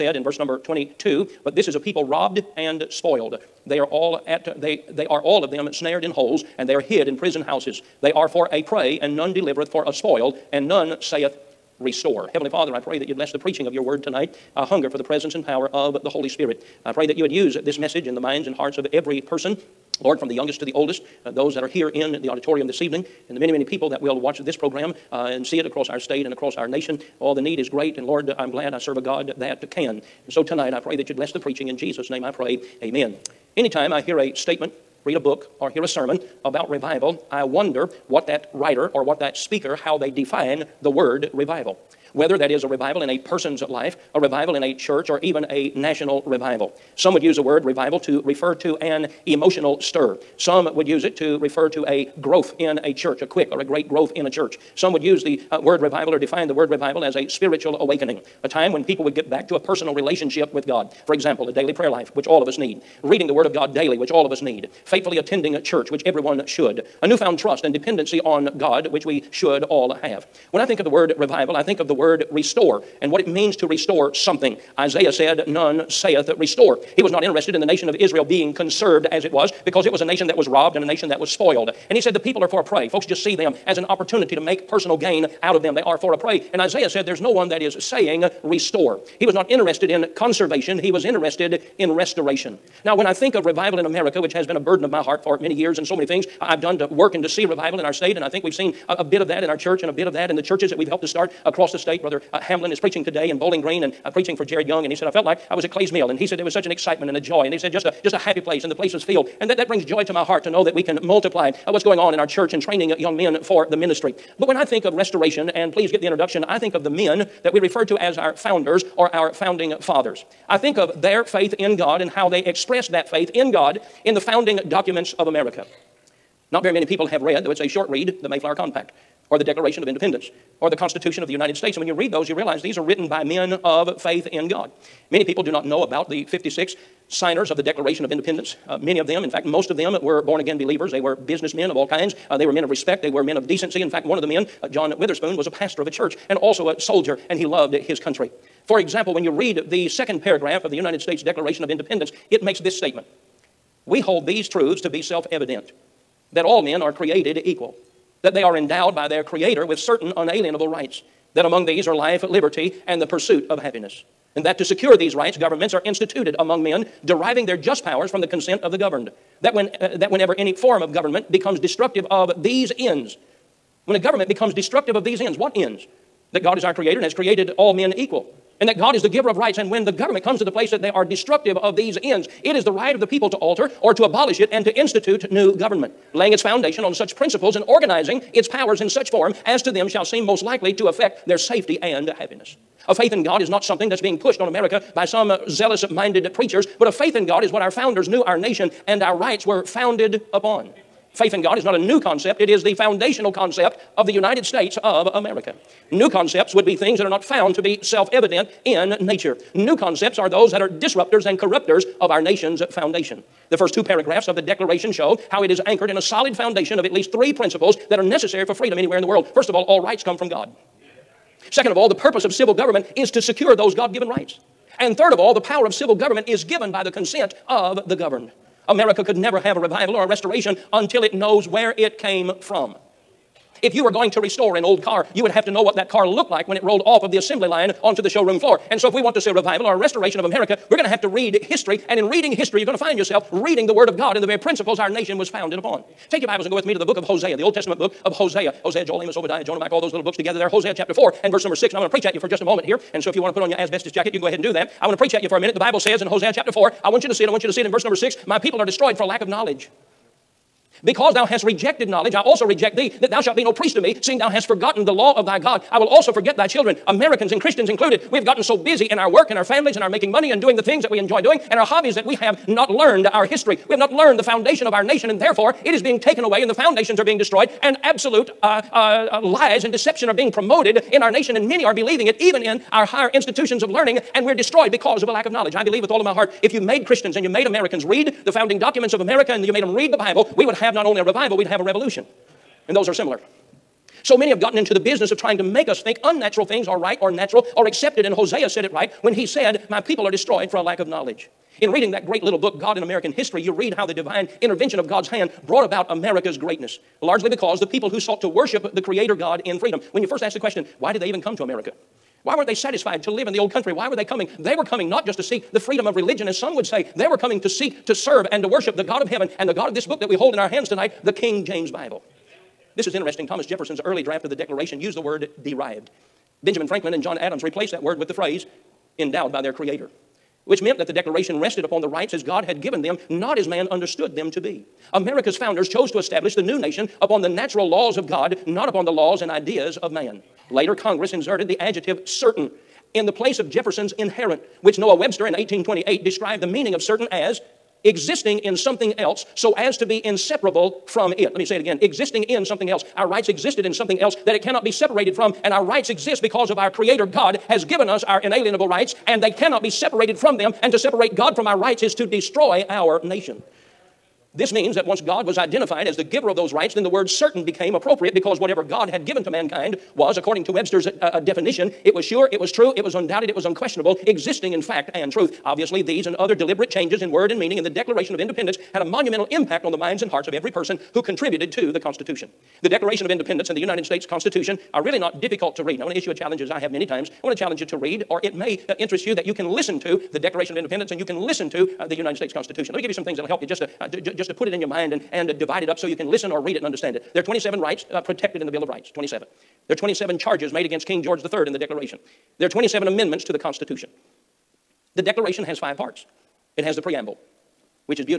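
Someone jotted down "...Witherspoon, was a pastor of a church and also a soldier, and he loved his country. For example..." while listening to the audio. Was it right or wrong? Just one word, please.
right.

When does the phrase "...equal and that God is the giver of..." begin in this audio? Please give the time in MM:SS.
02:57.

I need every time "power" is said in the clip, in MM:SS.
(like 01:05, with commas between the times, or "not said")
00:15, 02:47, 03:08, 03:45.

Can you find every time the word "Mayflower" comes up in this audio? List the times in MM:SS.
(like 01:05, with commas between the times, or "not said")
02:08.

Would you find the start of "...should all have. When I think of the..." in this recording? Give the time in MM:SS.
01:09.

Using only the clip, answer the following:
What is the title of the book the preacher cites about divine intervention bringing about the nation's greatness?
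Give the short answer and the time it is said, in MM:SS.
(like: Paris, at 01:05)
God in American History, at 05:02.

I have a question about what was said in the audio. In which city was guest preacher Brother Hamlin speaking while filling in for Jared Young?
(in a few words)
Bowling Green.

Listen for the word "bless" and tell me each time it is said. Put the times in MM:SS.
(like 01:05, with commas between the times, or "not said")
00:13, 00:31.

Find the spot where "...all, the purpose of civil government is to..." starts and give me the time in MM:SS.
03:41.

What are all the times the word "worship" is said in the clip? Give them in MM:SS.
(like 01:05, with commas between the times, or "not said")
05:08, 05:18.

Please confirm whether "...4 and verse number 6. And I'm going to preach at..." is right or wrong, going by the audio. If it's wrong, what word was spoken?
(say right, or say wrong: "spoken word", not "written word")
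right.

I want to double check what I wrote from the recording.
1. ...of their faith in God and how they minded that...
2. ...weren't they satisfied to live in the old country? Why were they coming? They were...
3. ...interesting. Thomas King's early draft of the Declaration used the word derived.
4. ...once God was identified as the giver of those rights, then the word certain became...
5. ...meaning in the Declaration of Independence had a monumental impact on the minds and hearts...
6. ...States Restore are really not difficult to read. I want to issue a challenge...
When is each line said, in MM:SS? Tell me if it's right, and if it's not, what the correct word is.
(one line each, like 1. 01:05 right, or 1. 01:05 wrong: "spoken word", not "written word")
1. 02:00 wrong: "expressed", not "minded"
2. 05:12 right
3. 05:22 wrong: "Jefferson", not "King"
4. 06:04 right
5. 06:17 right
6. 06:23 wrong: "Constitution", not "Restore".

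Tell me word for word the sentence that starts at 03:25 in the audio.
New concepts would be things that are not found to be self evident in nature.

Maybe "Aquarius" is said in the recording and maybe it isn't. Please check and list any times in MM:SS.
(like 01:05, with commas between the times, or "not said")
not said.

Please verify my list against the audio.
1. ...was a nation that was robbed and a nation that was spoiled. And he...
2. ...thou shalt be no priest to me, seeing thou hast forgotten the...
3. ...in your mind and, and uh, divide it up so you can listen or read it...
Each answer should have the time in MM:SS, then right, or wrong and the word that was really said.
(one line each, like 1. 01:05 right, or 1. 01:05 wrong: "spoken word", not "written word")
1. 01:19 right
2. 04:23 right
3. 06:34 right.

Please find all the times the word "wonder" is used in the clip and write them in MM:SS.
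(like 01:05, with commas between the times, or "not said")
00:37.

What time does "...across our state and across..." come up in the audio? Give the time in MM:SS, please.
00:25.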